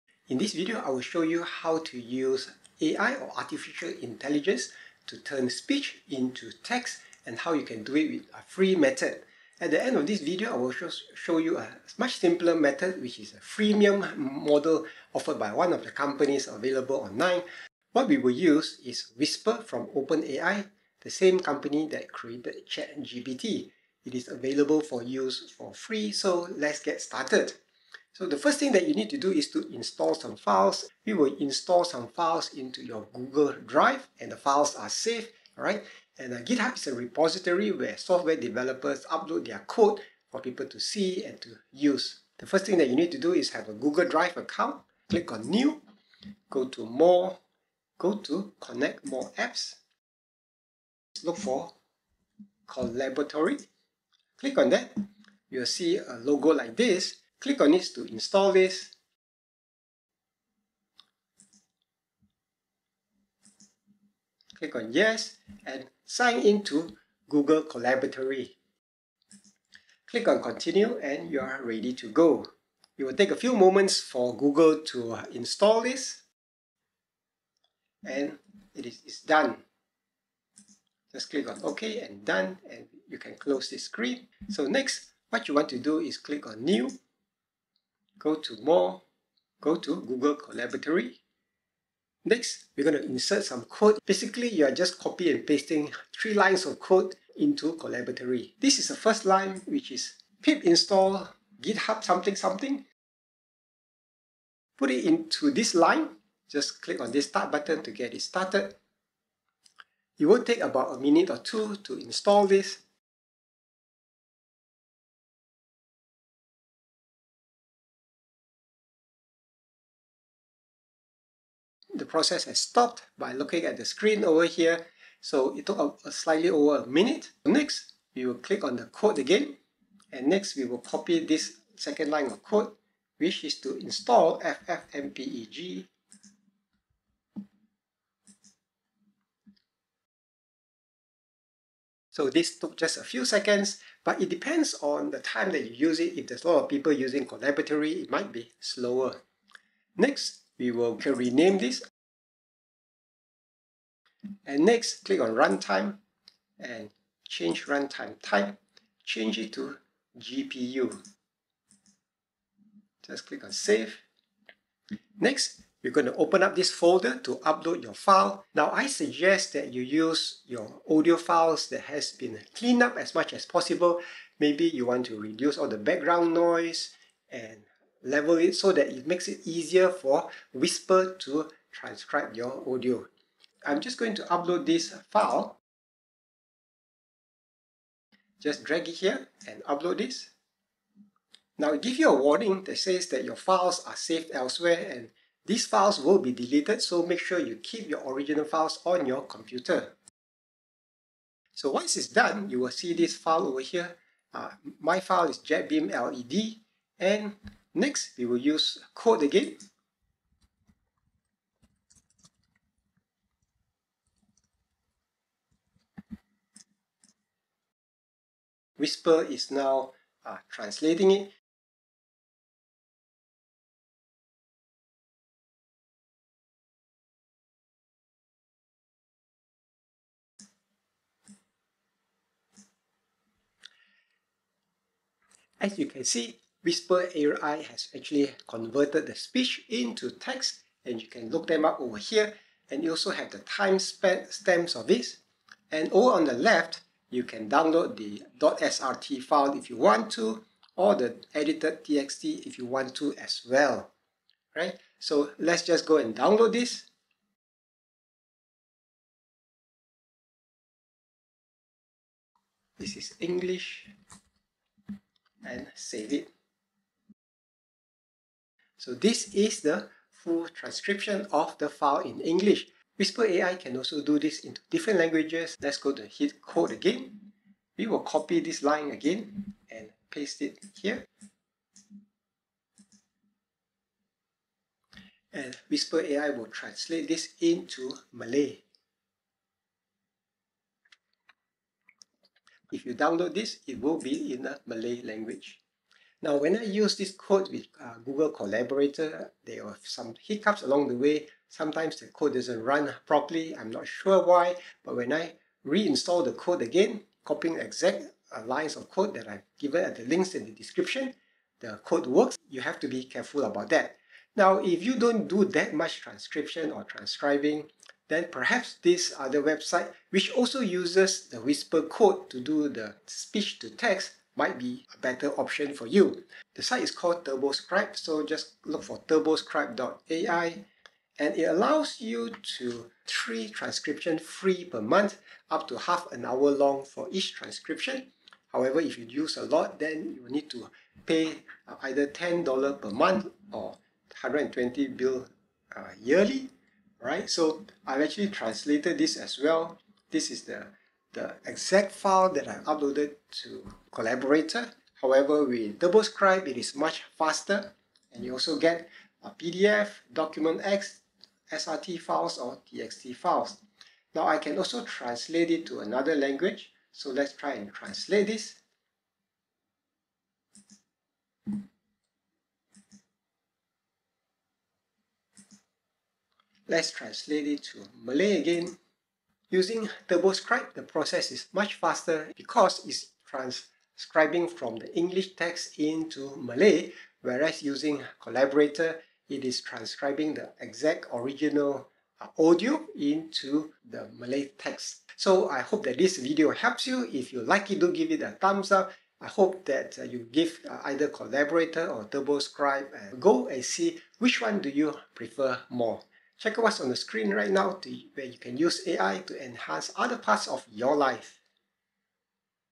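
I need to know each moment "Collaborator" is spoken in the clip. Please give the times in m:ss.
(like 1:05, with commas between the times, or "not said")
4:58, 5:53, 6:28, 6:41.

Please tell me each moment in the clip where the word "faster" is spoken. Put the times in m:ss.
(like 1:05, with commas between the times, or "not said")
5:57, 6:21.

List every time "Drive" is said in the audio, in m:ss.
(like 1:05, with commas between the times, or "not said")
0:33, 0:44.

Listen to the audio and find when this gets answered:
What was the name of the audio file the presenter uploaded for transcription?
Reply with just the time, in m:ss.
3:25.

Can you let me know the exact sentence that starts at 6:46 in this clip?
Check what's on the screen right now to, where you can use AI to enhance other parts of your life.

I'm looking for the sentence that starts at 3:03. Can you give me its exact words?
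I'm just going to upload this file.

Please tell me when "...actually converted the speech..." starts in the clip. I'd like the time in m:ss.
3:57.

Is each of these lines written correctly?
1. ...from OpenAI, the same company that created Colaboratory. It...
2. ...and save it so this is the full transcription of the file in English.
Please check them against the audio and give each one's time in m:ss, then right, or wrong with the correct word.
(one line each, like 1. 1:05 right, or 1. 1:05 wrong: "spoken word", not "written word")
1. 0:19 wrong: "ChatGPT", not "Colaboratory"
2. 4:25 right.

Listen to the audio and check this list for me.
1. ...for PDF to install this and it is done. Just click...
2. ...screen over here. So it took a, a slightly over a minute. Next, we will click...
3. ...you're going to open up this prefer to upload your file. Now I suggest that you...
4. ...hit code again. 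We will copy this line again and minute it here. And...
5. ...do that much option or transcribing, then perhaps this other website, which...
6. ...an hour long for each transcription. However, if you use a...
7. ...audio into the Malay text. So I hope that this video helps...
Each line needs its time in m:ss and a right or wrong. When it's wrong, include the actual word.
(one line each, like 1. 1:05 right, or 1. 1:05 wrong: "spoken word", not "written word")
1. 1:13 wrong: "Google", not "PDF"
2. 2:03 right
3. 2:45 wrong: "folder", not "prefer"
4. 4:36 wrong: "paste", not "minute"
5. 5:15 wrong: "transcription", not "option"
6. 5:36 right
7. 6:32 right.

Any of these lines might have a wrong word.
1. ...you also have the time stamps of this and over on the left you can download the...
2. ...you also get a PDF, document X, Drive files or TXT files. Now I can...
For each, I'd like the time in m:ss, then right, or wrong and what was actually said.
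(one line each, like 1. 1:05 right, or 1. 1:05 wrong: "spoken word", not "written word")
1. 4:02 right
2. 5:58 wrong: "SRT", not "Drive".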